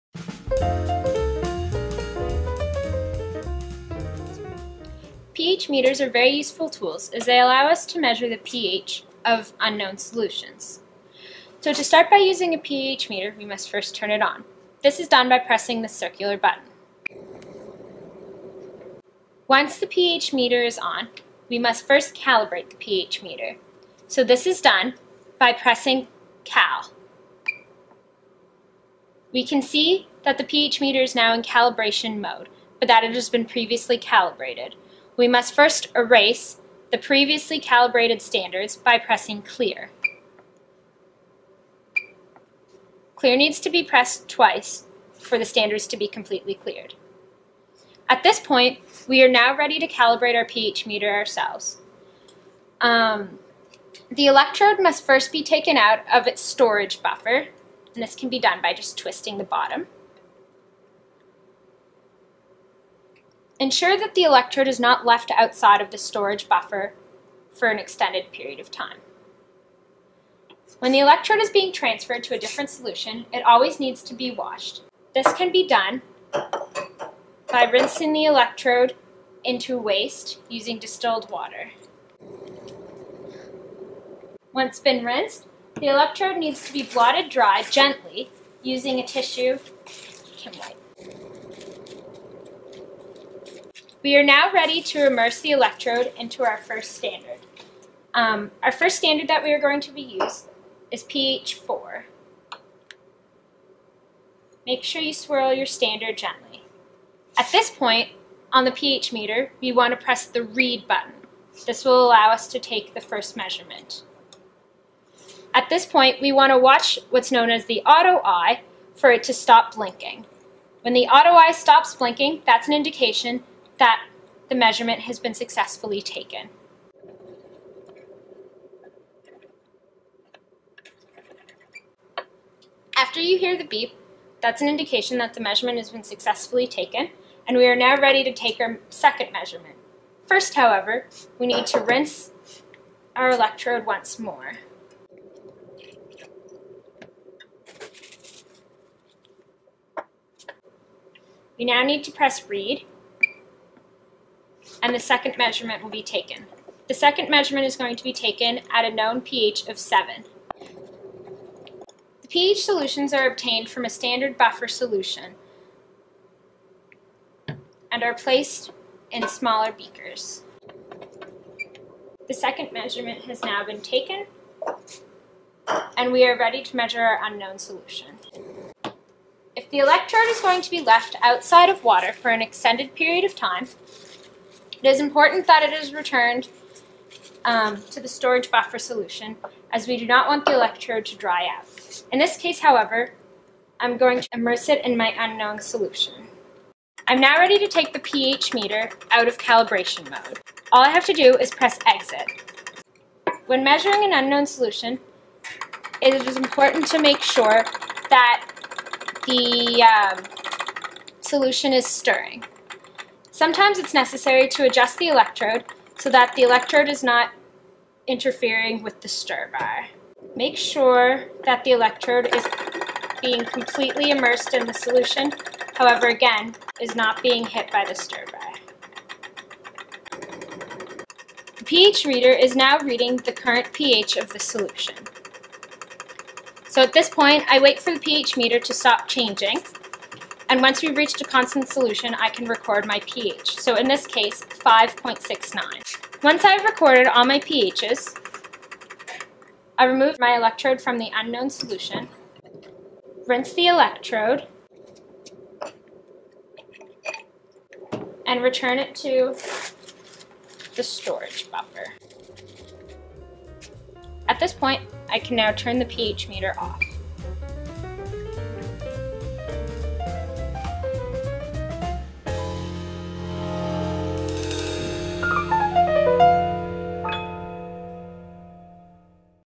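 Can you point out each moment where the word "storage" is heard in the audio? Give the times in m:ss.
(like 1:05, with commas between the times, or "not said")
0:56, 1:05, 3:08, 4:20.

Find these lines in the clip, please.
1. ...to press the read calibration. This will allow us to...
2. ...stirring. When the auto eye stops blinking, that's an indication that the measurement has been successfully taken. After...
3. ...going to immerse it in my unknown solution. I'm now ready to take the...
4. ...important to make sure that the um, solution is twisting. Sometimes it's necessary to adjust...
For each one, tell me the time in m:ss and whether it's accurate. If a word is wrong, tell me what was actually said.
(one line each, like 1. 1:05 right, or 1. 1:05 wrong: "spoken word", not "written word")
1. 1:49 wrong: "button", not "calibration"
2. 1:59 wrong: "blinking", not "stirring"
3. 3:13 right
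4. 3:26 wrong: "stirring", not "twisting".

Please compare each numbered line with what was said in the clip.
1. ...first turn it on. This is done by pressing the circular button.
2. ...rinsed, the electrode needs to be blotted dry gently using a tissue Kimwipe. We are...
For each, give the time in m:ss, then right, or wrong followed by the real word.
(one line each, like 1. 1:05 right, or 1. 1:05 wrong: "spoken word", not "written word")
1. 0:13 right
2. 1:25 right.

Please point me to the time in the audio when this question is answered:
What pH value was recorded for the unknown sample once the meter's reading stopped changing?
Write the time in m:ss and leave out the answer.
4:04.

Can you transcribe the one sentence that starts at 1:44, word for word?
Make sure you swirl your standard gently.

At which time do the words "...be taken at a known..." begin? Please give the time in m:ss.
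2:38.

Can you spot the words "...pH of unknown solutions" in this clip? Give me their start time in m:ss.
0:08.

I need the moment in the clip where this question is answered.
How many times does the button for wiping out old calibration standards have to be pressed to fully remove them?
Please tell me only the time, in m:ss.
0:44.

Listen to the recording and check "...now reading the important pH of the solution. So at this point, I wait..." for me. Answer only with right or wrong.
wrong.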